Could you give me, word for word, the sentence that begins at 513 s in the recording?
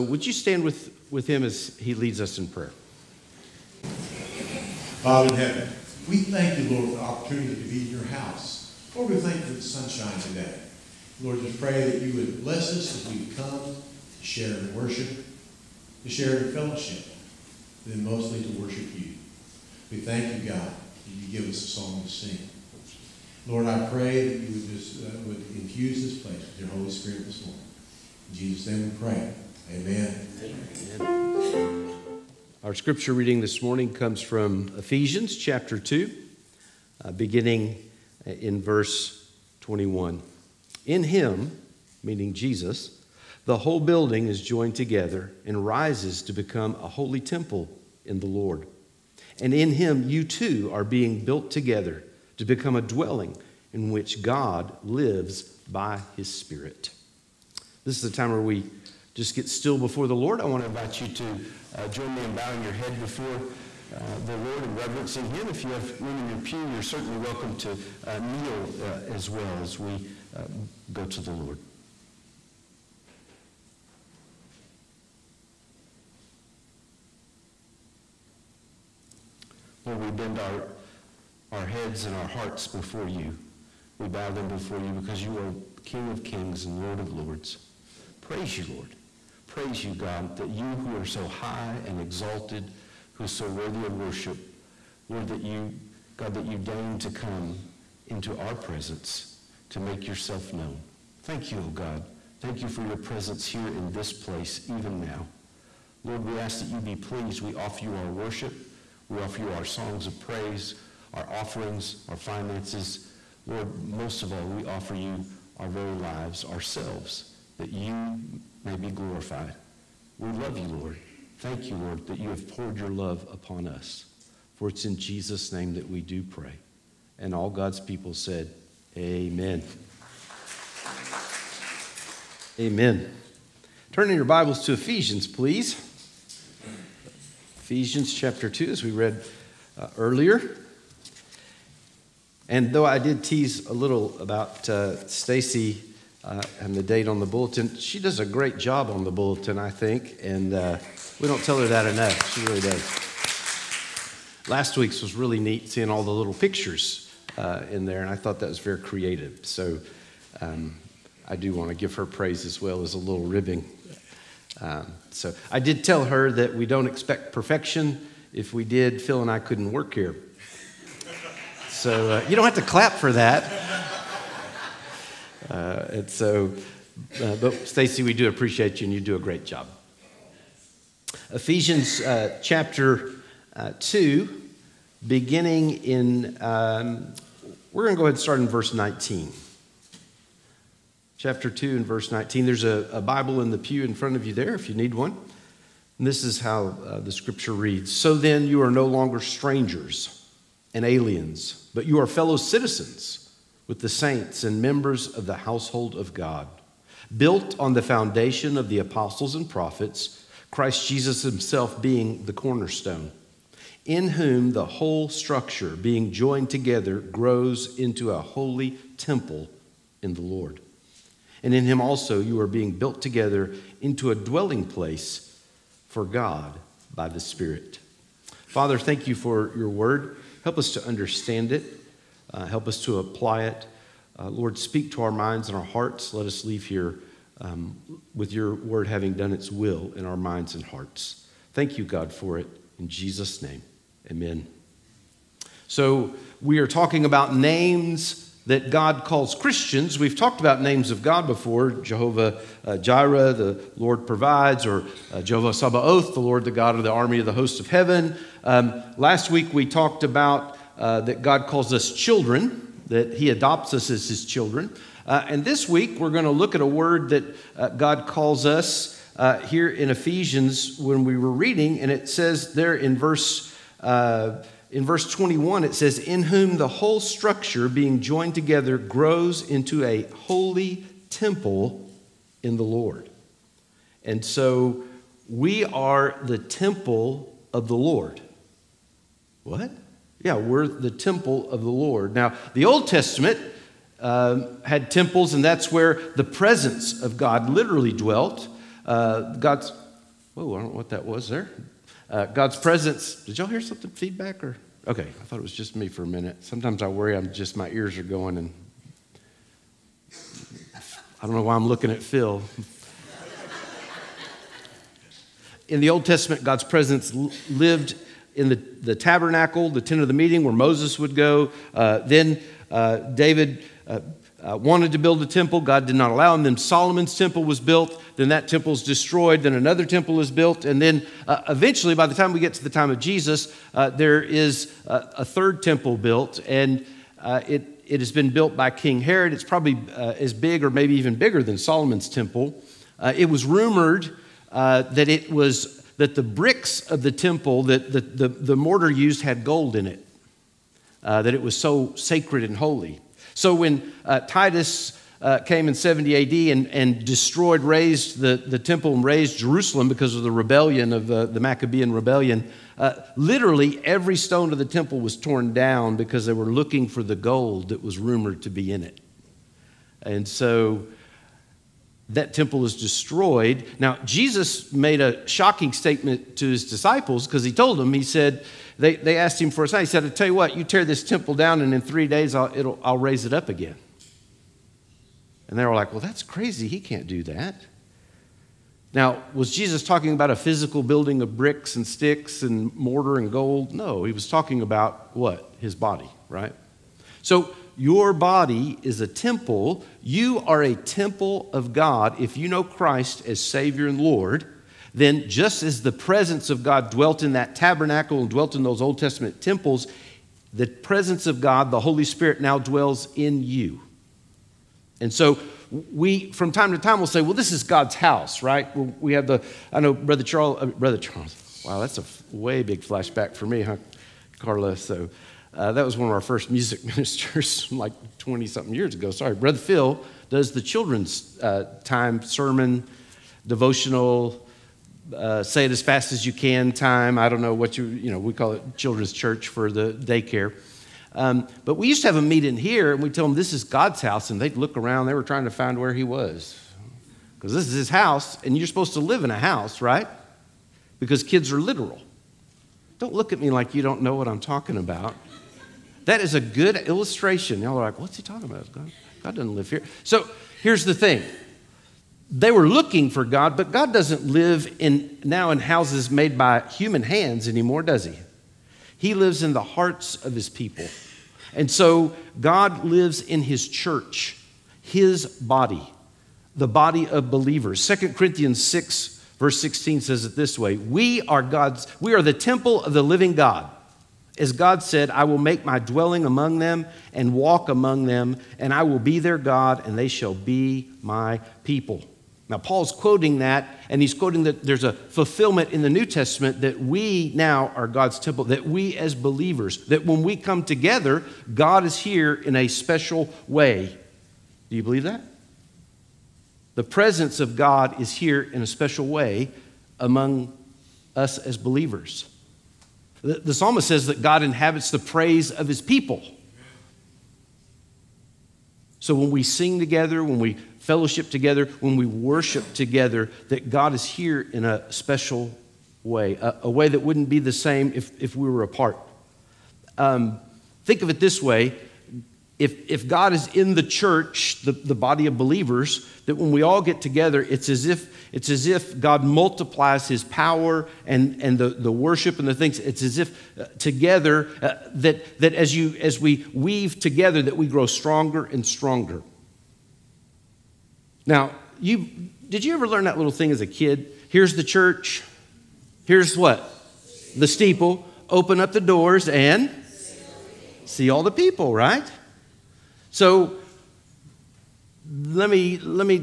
The, the psalmist says that God inhabits the praise of his people.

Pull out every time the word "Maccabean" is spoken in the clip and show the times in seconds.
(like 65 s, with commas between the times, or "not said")
361 s.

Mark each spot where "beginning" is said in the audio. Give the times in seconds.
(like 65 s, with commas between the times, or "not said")
37 s, 185 s.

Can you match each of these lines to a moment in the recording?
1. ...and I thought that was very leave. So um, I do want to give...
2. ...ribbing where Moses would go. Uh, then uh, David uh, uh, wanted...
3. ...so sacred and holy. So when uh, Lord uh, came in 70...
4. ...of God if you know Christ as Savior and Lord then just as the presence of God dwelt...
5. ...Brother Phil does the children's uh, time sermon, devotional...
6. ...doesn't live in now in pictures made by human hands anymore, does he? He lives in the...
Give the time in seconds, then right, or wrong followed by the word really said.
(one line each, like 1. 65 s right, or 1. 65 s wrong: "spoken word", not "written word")
1. 158 s wrong: "creative", not "leave"
2. 320 s wrong: "meeting", not "ribbing"
3. 351 s wrong: "Titus", not "Lord"
4. 401 s right
5. 429 s right
6. 463 s wrong: "houses", not "pictures".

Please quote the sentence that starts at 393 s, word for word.
No, he was talking about what?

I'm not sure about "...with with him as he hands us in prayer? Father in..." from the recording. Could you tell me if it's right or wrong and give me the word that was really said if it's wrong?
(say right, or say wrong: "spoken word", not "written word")
wrong: "leads", not "hands".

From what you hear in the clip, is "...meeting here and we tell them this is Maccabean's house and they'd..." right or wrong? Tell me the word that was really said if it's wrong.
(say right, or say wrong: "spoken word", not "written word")
wrong: "God", not "Maccabean".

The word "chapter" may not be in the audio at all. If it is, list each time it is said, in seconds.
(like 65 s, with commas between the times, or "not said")
35 s, 138 s, 182 s, 191 s.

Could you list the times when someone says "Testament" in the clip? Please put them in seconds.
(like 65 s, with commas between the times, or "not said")
292 s, 316 s, 408 s, 496 s.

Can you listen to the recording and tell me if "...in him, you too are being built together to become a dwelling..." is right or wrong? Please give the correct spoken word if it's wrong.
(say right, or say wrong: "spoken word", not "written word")
right.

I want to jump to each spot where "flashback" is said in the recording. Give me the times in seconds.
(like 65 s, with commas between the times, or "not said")
422 s.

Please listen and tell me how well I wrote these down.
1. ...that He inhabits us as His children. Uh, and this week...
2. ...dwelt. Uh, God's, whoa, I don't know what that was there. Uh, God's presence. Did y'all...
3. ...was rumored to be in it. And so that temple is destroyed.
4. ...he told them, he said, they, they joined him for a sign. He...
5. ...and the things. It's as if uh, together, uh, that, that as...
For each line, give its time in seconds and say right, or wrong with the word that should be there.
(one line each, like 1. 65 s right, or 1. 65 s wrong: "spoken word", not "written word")
1. 262 s wrong: "adopts", not "inhabits"
2. 297 s right
3. 367 s right
4. 377 s wrong: "asked", not "joined"
5. 542 s right.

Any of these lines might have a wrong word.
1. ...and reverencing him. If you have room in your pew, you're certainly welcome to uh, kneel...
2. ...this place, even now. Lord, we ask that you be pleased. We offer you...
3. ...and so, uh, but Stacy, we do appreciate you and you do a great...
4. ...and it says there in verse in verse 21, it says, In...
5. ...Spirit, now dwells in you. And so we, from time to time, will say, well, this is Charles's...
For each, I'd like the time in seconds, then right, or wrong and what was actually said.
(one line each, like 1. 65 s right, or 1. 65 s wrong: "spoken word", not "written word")
1. 64 s right
2. 103 s right
3. 175 s right
4. 271 s right
5. 412 s wrong: "God", not "Charles".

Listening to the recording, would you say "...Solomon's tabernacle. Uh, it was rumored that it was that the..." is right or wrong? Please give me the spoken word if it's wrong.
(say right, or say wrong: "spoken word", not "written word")
wrong: "temple", not "tabernacle".